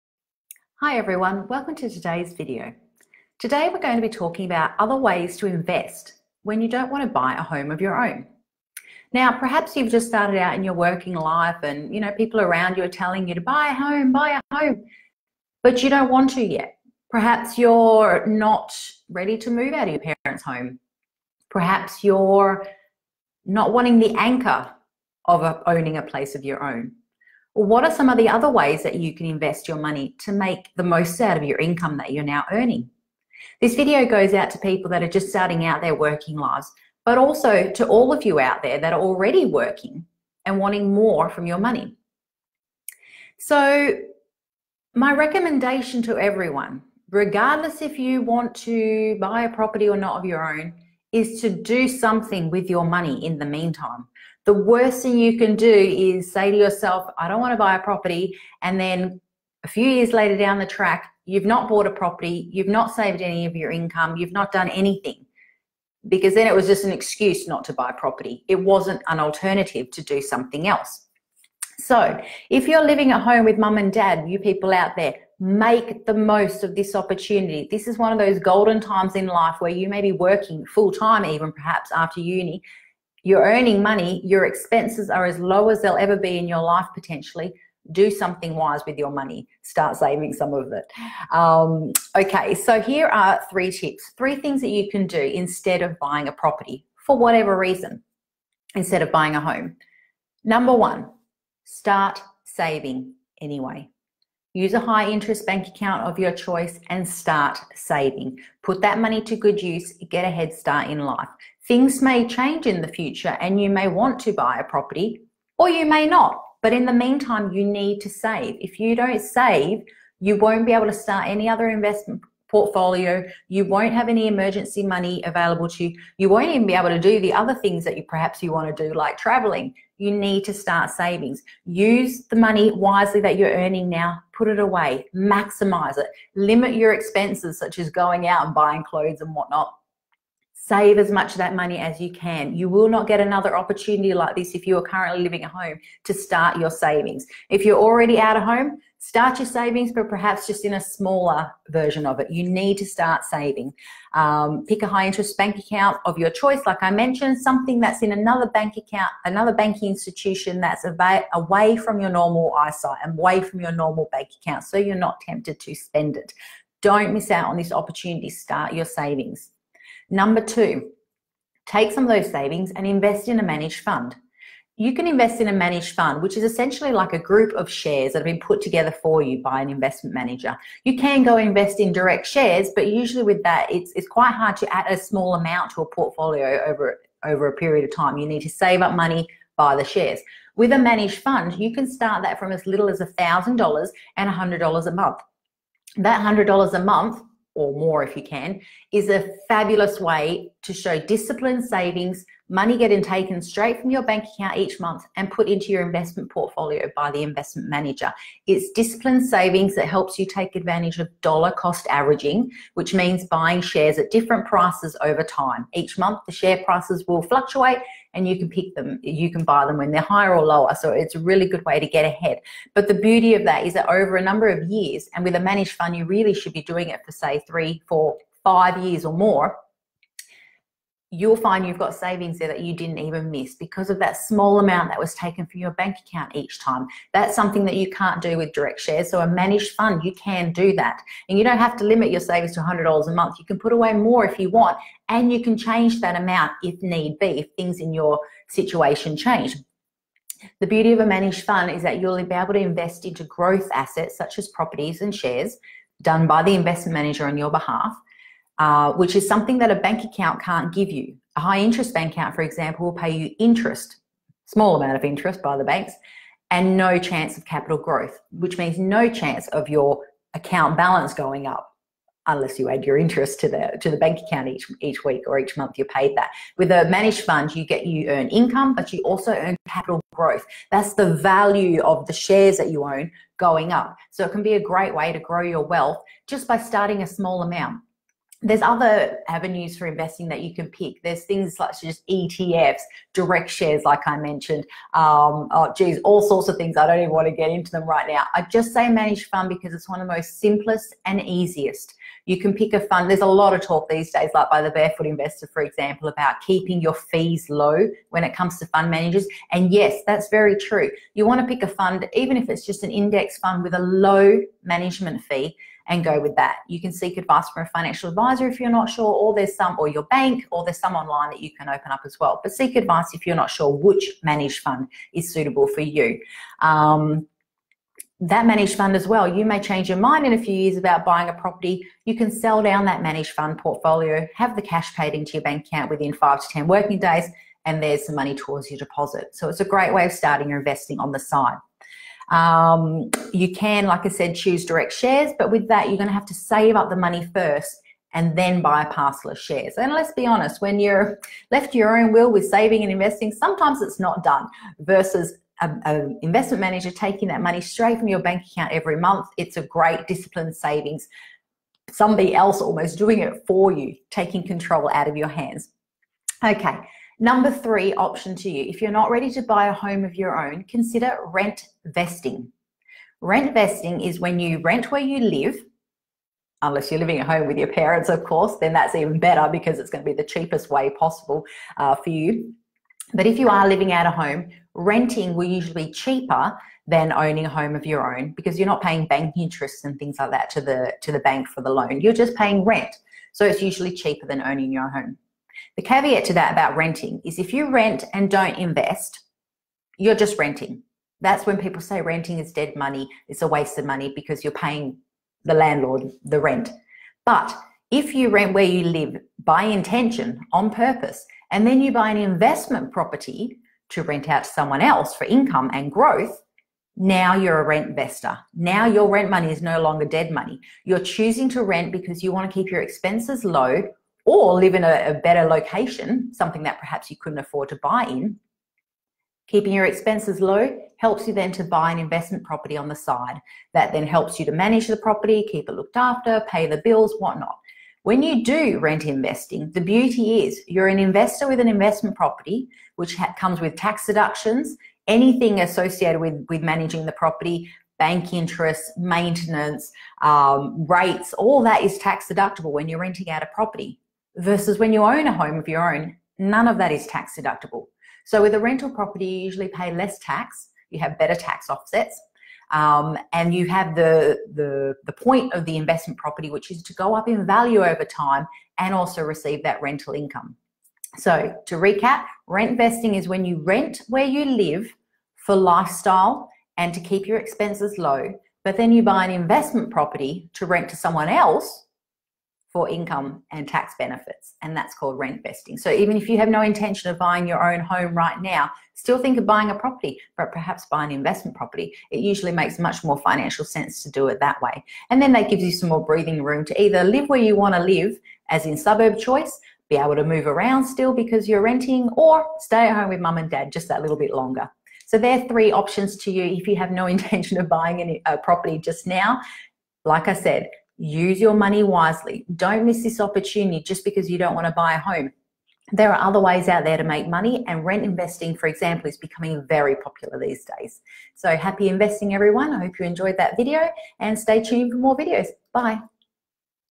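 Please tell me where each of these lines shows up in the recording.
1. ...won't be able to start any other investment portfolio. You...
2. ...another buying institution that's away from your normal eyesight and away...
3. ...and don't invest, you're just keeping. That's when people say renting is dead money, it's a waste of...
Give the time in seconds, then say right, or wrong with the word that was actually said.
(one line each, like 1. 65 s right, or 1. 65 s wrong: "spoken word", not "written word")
1. 120 s right
2. 159 s wrong: "banking", not "buying"
3. 398 s wrong: "renting", not "keeping".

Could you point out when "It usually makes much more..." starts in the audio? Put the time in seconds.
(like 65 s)
492 s.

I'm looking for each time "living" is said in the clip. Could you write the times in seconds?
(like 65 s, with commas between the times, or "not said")
72 s, 145 s, 376 s, 383 s.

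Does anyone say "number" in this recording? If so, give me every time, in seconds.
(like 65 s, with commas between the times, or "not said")
100 s, 170 s, 224 s, 367 s.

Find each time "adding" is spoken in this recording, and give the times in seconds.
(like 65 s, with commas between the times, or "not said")
not said.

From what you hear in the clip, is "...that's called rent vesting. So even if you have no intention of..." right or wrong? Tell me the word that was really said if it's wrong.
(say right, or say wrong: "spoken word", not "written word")
right.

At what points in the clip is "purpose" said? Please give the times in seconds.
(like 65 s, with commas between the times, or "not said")
410 s.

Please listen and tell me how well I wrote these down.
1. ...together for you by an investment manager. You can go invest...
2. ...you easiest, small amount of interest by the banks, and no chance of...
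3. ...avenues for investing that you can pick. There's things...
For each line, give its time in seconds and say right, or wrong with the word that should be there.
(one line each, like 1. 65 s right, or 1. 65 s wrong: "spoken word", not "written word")
1. 178 s right
2. 263 s wrong: "interest", not "easiest"
3. 289 s right.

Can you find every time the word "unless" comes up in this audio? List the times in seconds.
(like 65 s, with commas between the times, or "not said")
272 s, 376 s.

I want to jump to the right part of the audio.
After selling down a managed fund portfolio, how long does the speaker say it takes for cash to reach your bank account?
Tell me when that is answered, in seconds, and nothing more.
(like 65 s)
336 s.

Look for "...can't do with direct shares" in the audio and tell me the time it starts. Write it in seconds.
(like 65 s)
237 s.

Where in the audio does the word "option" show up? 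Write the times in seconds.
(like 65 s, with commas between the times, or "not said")
367 s, 505 s.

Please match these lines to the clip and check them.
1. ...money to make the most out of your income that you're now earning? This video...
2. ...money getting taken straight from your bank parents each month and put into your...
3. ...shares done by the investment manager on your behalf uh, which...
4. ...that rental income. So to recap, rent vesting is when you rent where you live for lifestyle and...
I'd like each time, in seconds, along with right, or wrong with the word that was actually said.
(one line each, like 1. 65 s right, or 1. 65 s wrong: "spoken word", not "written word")
1. 29 s right
2. 202 s wrong: "account", not "parents"
3. 255 s right
4. 469 s right.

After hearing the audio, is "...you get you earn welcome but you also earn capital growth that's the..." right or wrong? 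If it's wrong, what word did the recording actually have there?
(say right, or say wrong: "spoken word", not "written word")
wrong: "income", not "welcome".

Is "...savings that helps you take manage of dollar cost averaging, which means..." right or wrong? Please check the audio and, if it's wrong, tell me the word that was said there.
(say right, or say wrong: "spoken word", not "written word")
wrong: "advantage", not "manage".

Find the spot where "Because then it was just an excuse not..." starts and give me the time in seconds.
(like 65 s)
66 s.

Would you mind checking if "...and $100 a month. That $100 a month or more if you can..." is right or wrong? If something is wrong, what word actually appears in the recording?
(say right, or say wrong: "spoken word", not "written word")
right.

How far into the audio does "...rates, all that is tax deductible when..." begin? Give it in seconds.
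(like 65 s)
450 s.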